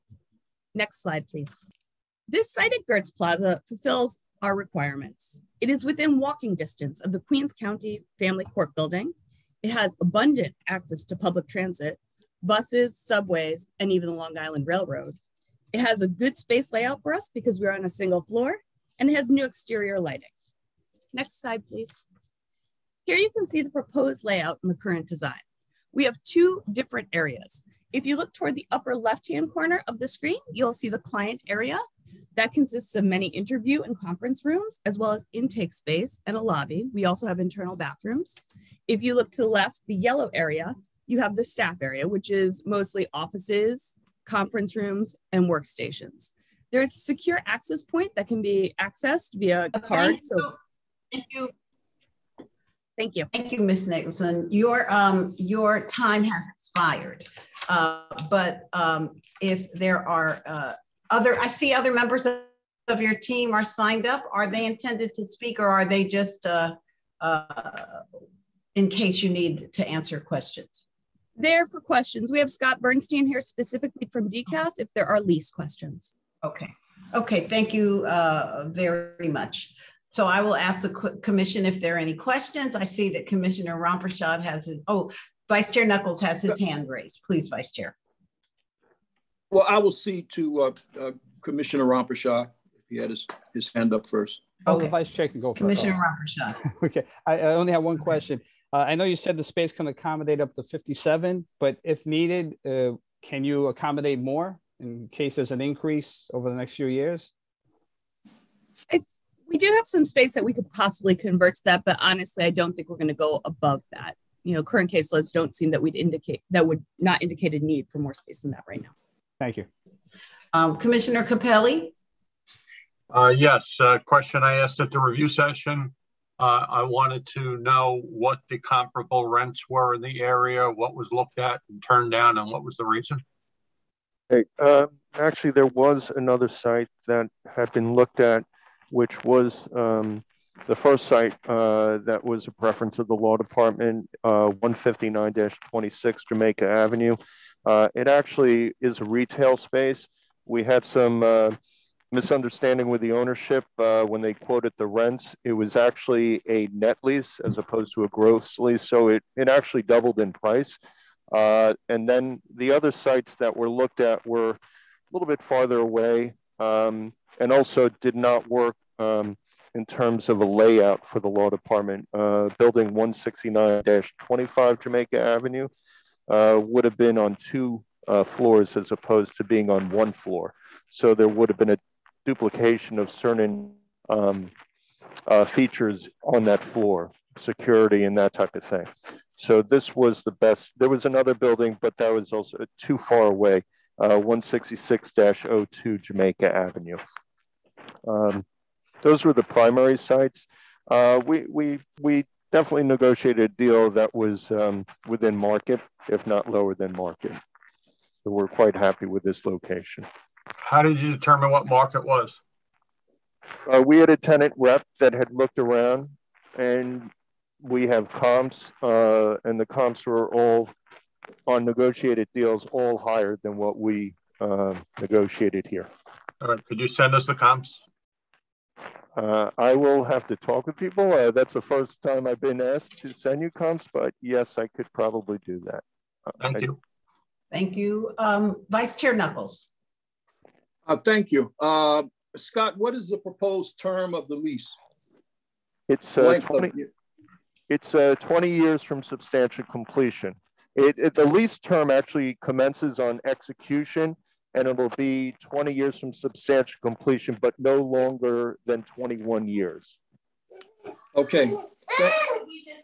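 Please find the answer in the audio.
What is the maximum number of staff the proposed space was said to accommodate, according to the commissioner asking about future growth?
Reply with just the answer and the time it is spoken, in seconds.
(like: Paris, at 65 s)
57, at 100 s.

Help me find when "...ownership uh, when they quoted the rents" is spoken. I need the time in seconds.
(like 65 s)
153 s.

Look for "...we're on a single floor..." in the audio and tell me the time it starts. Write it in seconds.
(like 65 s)
17 s.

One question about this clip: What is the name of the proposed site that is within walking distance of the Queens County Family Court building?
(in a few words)
Gertz Plaza.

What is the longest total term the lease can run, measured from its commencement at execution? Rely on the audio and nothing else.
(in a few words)
21 years.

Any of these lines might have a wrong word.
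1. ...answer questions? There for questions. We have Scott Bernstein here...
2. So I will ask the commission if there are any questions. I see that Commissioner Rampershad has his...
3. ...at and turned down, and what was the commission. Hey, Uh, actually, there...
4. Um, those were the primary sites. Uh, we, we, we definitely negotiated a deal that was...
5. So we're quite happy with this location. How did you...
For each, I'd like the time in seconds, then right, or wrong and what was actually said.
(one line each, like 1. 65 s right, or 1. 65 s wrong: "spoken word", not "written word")
1. 69 s right
2. 80 s right
3. 131 s wrong: "reason", not "commission"
4. 198 s right
5. 208 s right.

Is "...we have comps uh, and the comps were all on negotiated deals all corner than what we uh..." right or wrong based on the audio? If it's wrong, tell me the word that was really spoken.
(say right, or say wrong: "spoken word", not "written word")
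wrong: "higher", not "corner".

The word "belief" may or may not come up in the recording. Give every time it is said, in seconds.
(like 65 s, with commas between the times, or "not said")
not said.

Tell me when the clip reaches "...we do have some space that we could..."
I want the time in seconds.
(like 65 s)
109 s.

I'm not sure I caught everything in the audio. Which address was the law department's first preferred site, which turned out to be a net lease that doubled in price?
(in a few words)
159-26 Jamaica Avenue.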